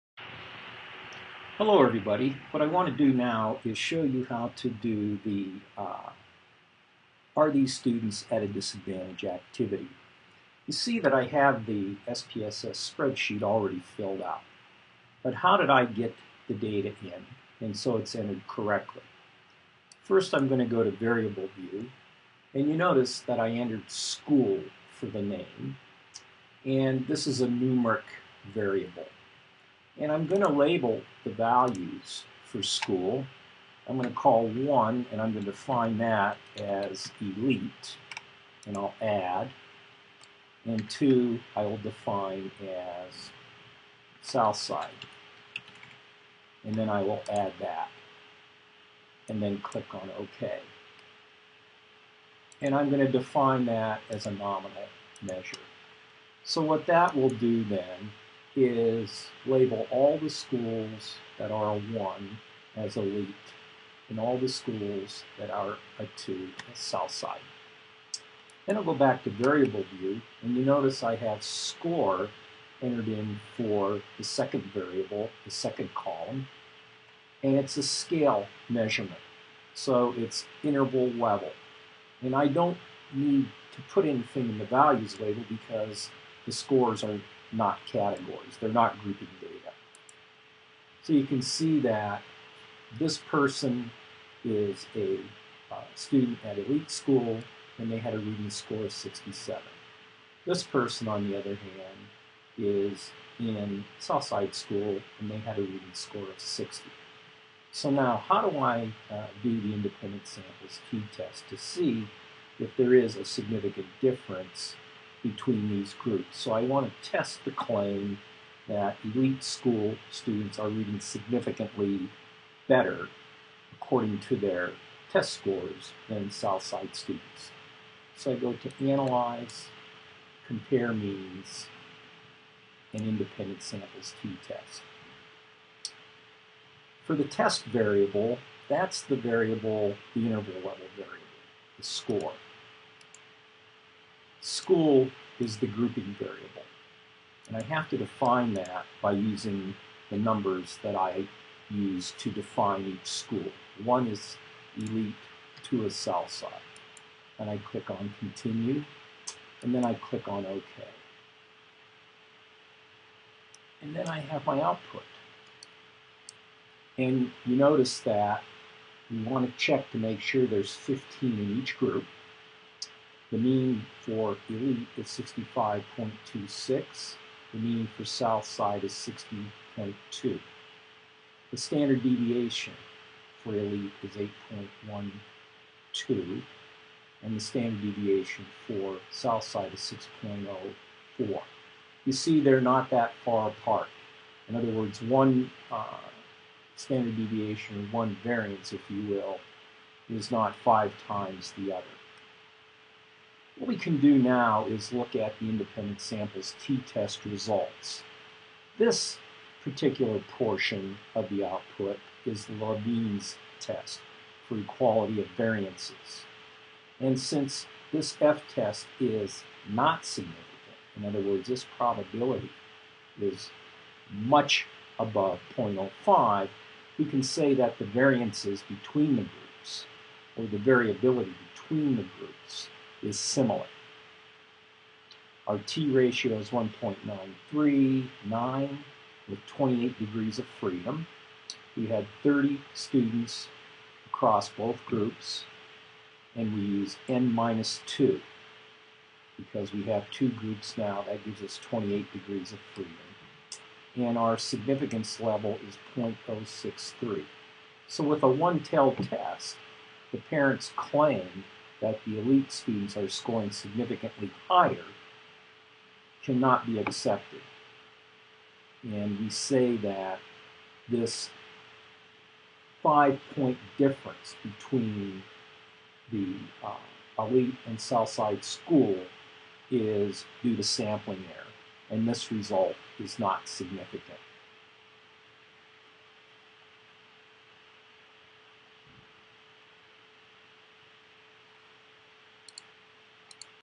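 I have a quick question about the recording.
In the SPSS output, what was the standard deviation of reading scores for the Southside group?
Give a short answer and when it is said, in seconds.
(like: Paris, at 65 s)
6.04, at 190 s.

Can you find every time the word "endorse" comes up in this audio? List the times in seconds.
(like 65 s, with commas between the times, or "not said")
not said.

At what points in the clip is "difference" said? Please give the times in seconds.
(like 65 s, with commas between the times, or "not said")
114 s, 273 s.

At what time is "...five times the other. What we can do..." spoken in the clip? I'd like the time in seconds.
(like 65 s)
200 s.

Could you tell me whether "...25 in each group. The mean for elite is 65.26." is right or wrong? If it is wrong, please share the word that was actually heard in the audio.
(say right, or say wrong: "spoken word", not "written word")
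wrong: "15", not "25".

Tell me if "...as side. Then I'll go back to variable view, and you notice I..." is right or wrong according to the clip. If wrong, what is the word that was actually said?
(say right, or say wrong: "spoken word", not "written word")
right.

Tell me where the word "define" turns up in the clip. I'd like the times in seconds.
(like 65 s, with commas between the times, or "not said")
35 s, 41 s, 53 s, 147 s, 152 s.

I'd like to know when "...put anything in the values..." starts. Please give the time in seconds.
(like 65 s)
83 s.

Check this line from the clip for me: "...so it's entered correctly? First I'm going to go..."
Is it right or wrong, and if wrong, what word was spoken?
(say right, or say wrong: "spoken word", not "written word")
right.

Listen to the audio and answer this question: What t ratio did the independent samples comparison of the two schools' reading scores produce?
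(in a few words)
1.939.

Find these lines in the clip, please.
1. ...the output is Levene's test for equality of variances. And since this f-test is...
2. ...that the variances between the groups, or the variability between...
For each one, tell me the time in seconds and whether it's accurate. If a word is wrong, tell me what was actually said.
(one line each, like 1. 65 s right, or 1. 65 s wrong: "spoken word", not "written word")
1. 211 s right
2. 227 s right.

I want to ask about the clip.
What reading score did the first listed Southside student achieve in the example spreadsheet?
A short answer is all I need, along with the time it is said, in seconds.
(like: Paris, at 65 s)
60, at 106 s.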